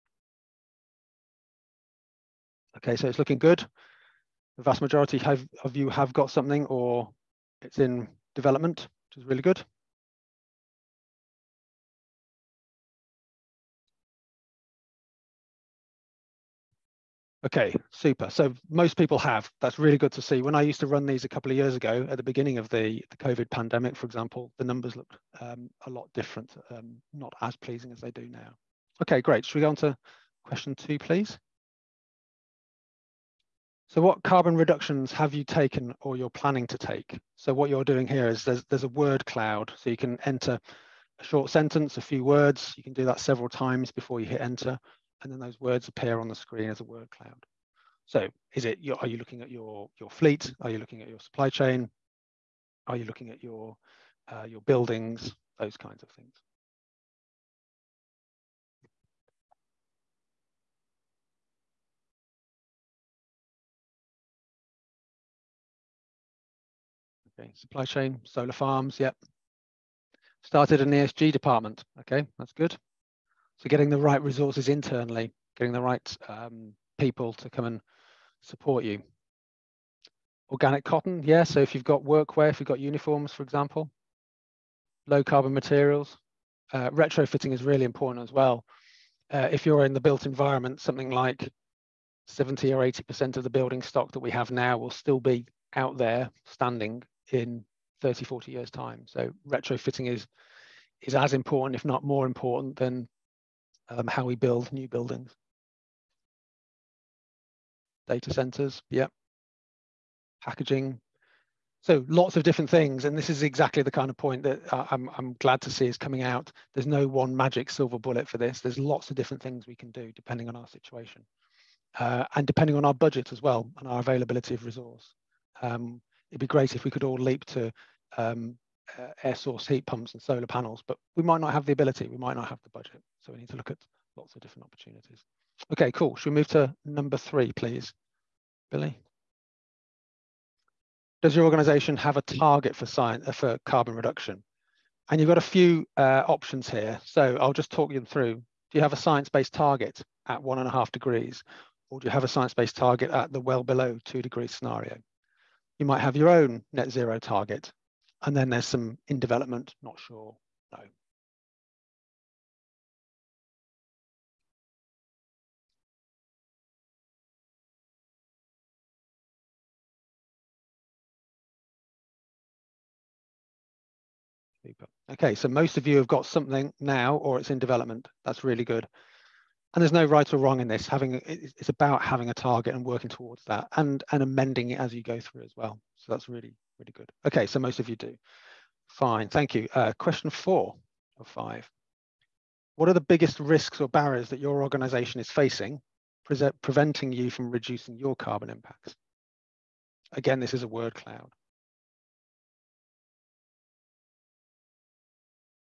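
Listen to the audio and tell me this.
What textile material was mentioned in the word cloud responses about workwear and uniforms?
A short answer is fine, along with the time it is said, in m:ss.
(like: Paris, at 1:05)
Organic cotton, at 1:20.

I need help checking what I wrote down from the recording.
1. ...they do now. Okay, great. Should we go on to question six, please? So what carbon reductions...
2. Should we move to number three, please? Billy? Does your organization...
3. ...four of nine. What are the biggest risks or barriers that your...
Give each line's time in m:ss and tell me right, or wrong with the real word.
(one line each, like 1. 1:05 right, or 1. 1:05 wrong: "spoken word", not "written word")
1. 0:27 wrong: "two", not "six"
2. 2:16 right
3. 3:10 wrong: "five", not "nine".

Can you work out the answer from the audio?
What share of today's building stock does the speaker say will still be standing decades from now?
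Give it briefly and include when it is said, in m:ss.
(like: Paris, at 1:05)
70 or 80%, at 1:32.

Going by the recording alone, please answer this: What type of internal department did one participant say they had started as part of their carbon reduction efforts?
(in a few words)
ESG department.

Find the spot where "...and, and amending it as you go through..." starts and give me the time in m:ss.
3:03.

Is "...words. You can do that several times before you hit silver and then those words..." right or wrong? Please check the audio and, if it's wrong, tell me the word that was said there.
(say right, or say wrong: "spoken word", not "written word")
wrong: "enter", not "silver".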